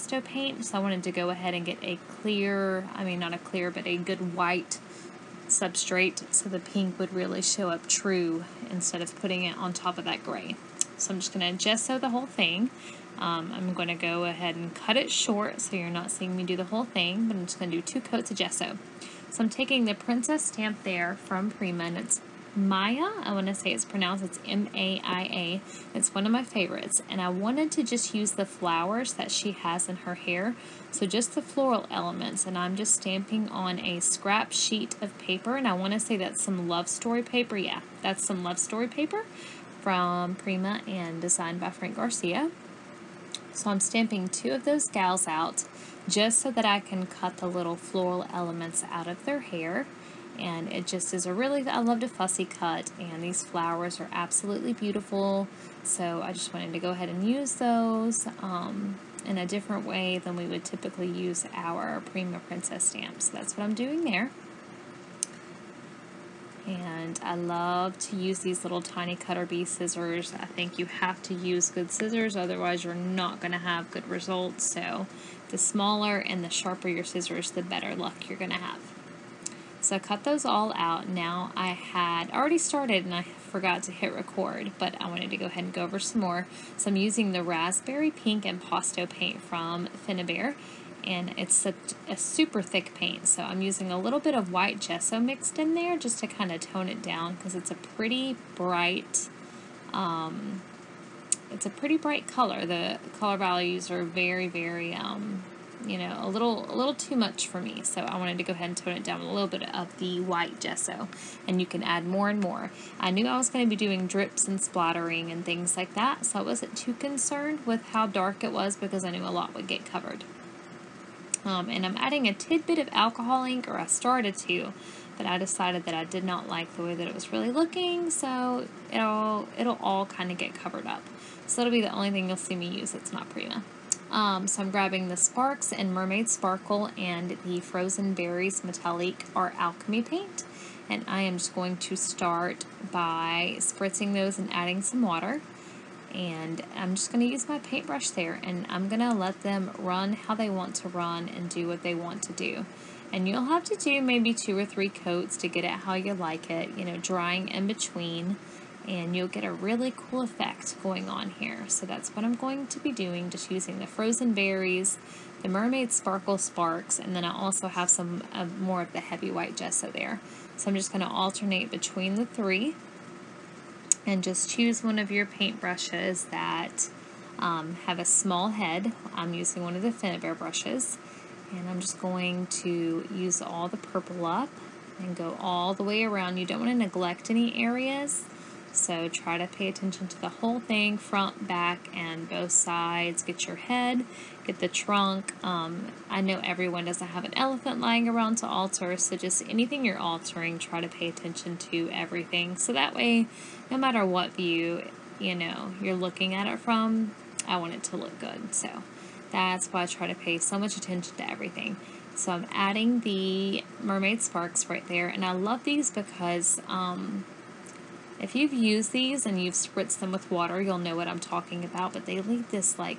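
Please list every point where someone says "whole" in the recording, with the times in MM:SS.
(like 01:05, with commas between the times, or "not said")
00:12, 00:16, 03:10.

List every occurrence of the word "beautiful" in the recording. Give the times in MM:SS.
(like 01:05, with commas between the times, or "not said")
00:54.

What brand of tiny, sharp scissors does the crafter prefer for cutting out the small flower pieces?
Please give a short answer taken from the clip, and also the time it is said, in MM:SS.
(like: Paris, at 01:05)
Cutter Bee, at 01:09.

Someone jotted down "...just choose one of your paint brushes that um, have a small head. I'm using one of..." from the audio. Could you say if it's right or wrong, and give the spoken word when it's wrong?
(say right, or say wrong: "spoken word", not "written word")
right.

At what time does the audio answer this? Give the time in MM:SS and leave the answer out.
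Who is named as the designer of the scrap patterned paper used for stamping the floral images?
00:41.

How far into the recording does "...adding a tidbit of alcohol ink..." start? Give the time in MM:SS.
02:01.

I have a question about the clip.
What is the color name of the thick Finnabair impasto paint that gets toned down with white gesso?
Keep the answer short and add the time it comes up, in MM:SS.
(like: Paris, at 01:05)
Raspberry Pink, at 01:27.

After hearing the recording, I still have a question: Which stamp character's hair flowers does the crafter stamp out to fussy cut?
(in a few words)
Maia.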